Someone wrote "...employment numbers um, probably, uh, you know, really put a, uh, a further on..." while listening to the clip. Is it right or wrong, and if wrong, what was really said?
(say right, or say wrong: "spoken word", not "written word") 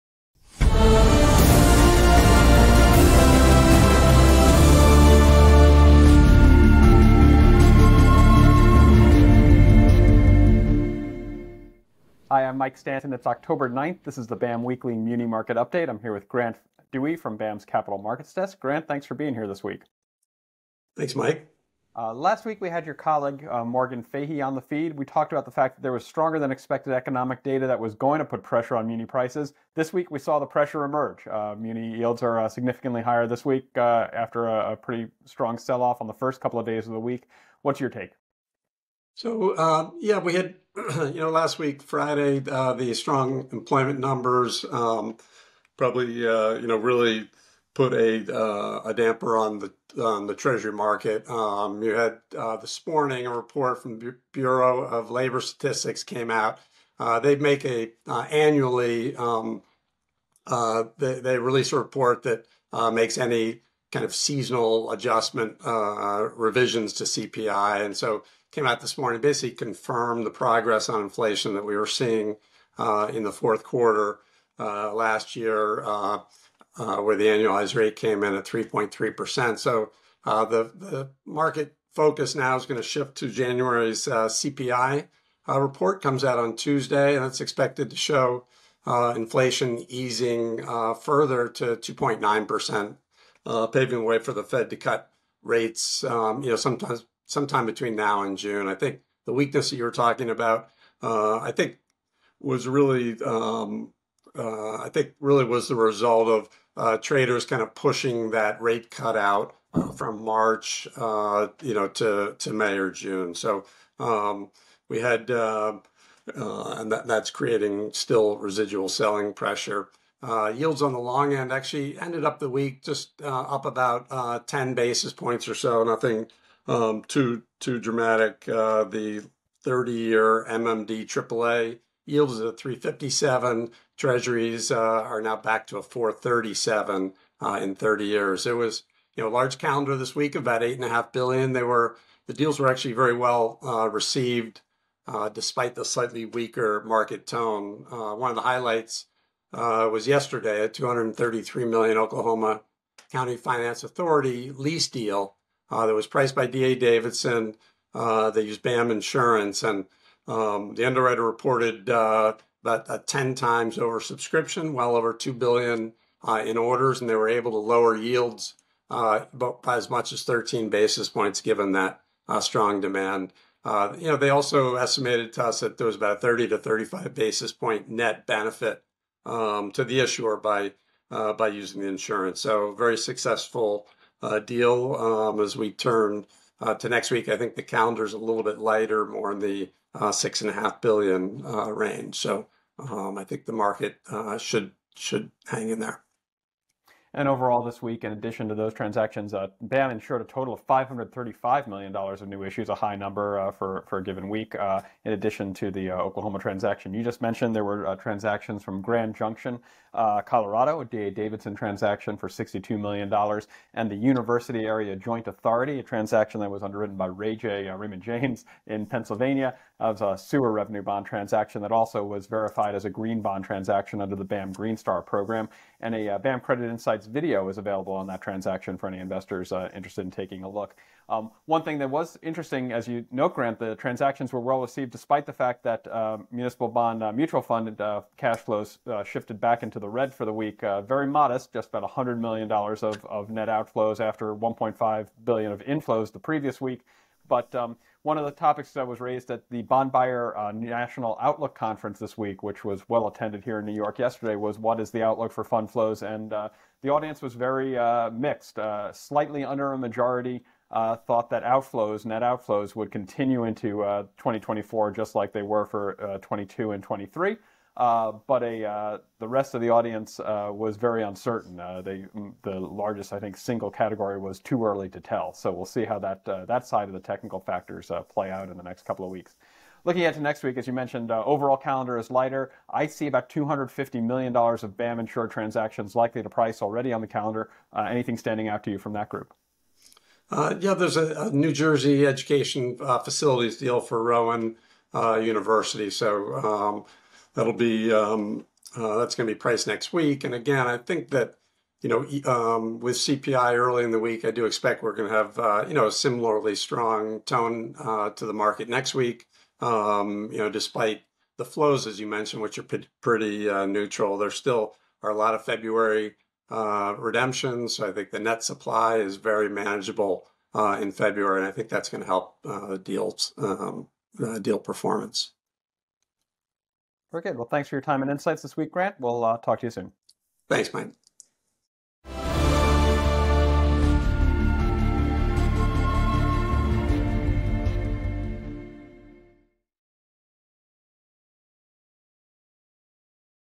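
wrong: "damper", not "further".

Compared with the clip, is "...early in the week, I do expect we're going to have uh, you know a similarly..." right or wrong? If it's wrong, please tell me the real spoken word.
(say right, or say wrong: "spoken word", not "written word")
right.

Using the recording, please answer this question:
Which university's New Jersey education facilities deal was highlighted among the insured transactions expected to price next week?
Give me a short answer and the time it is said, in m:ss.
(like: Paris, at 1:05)
Rowan University, at 4:54.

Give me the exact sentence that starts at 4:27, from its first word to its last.
Uh, but a, uh, the rest of the audience uh, was very uncertain.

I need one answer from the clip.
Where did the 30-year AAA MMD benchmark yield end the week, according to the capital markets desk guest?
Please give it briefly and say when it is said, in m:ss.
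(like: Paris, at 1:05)
357, at 2:12.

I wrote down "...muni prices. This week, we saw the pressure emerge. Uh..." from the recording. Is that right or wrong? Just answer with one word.
right.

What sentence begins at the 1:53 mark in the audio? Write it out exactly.
So um, we had, uh, uh, and that, that's creating still residual selling pressure.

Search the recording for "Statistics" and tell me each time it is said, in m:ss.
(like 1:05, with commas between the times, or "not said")
0:55.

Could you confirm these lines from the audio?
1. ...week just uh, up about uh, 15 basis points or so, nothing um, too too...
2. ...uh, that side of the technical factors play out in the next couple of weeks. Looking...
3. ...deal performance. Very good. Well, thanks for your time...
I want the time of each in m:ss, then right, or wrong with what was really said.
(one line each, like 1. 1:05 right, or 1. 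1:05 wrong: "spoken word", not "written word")
1. 2:02 wrong: "10", not "15"
2. 4:36 right
3. 5:24 right.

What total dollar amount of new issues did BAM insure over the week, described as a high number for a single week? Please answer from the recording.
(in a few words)
$535 million.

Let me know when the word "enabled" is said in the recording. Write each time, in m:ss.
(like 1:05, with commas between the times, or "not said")
not said.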